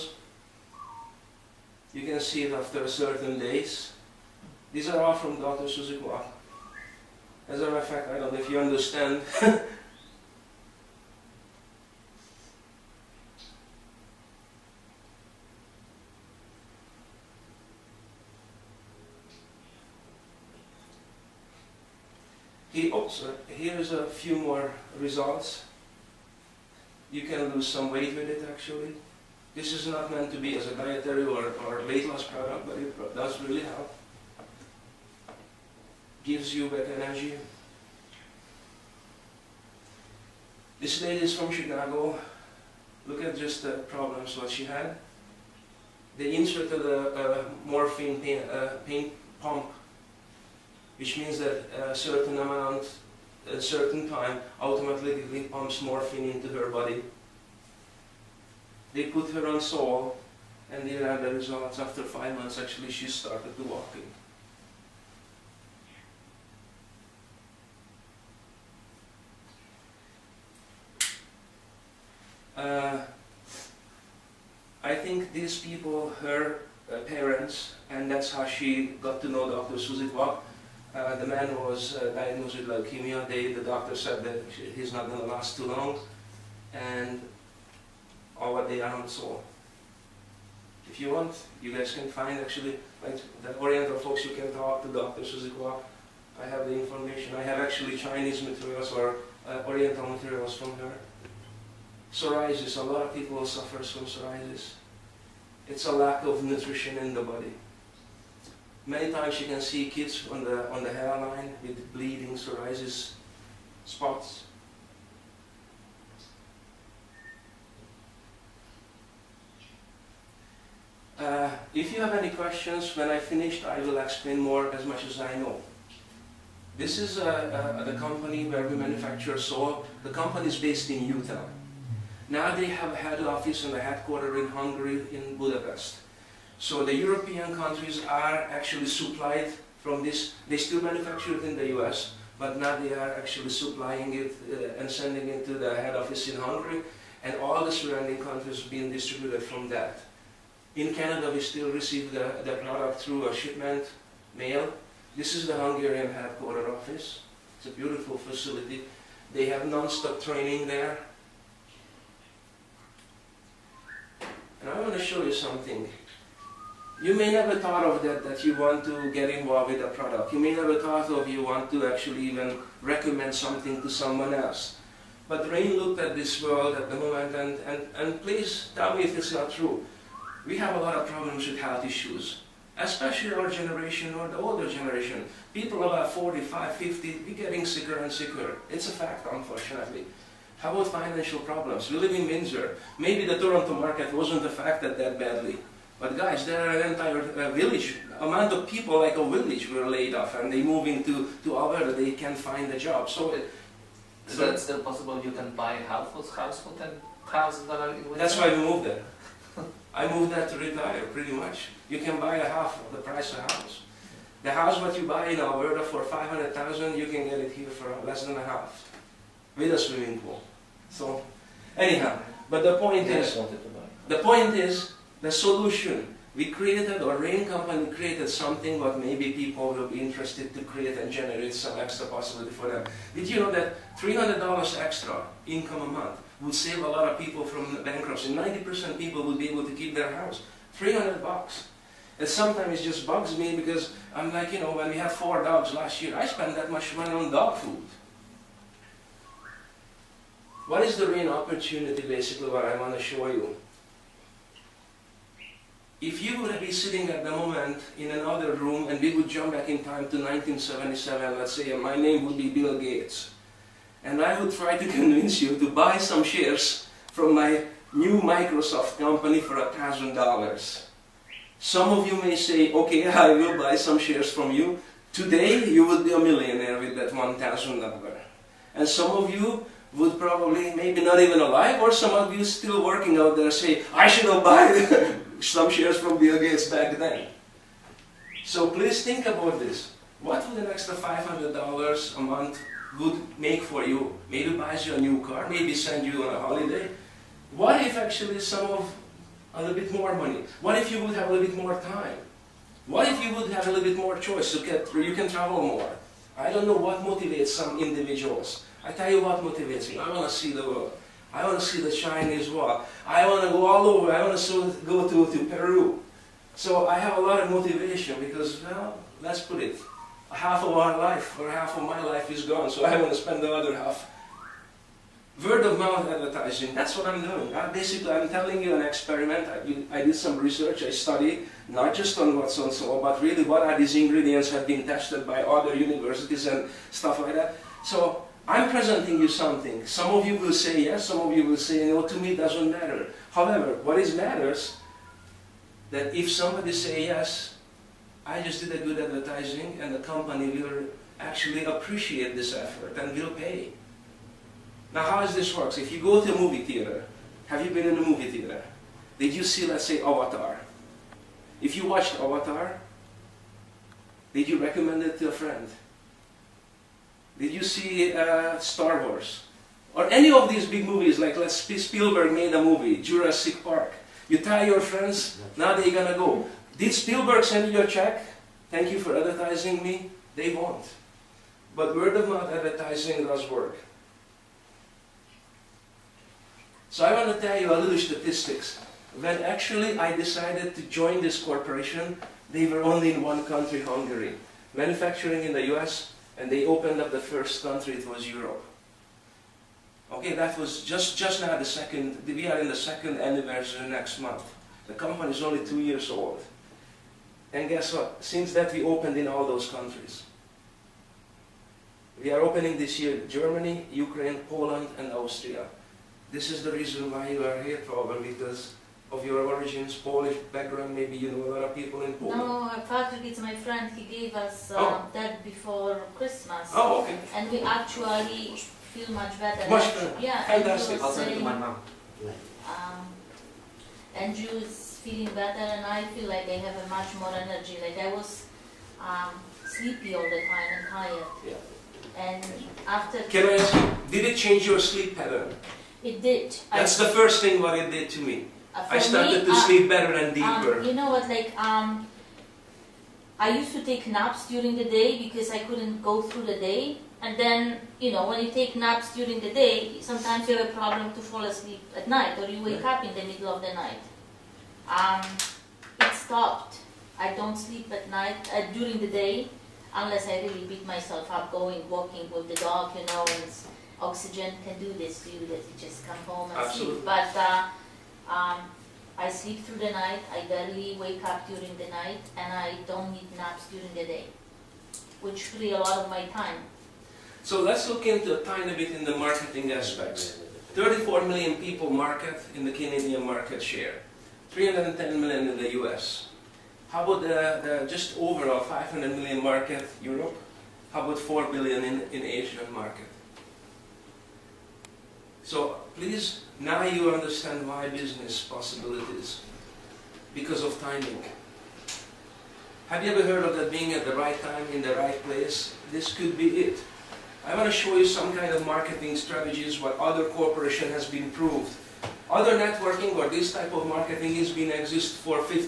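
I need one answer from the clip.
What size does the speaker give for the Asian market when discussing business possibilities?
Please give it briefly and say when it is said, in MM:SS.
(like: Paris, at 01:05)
4 billion, at 08:21.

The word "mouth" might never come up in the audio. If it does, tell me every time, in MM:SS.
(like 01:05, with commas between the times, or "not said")
05:25, 06:22.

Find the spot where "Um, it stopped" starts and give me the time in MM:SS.
07:44.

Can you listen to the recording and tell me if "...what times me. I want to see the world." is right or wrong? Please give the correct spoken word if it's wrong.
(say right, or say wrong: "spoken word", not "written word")
wrong: "motivates", not "times".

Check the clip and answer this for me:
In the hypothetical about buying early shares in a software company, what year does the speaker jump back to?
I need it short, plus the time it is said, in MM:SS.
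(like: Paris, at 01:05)
1977, at 04:20.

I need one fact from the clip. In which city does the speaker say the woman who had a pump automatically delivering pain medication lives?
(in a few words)
Chicago.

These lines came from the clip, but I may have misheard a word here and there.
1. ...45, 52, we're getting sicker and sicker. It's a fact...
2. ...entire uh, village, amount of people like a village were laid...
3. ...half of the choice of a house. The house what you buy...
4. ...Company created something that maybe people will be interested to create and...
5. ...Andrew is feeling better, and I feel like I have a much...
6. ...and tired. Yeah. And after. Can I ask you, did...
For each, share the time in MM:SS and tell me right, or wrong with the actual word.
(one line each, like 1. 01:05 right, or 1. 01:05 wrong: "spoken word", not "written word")
1. 03:06 wrong: "50", not "52"
2. 03:16 right
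3. 03:32 wrong: "price", not "choice"
4. 03:47 right
5. 07:14 right
6. 07:20 right.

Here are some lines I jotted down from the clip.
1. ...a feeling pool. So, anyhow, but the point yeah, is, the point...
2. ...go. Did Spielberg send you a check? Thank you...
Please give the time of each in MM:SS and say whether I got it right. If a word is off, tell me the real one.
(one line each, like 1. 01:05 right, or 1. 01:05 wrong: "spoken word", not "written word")
1. 03:39 wrong: "swimming", not "feeling"
2. 06:16 right.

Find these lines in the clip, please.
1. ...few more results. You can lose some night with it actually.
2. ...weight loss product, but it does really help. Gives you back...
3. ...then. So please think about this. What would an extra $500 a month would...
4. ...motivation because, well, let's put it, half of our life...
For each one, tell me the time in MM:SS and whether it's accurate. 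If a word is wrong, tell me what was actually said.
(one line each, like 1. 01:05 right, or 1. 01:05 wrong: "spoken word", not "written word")
1. 00:24 wrong: "weight", not "night"
2. 00:31 right
3. 04:46 right
4. 05:17 right.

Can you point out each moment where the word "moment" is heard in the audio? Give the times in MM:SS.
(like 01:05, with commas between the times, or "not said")
02:56, 04:17.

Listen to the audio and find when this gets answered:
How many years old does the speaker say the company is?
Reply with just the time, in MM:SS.
06:45.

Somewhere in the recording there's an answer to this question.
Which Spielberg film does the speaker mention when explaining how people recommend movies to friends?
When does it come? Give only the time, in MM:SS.
06:13.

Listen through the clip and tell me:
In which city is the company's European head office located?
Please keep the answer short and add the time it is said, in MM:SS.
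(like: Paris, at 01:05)
Budapest, at 02:15.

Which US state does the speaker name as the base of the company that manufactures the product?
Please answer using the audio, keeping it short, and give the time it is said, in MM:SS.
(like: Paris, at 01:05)
Utah, at 02:11.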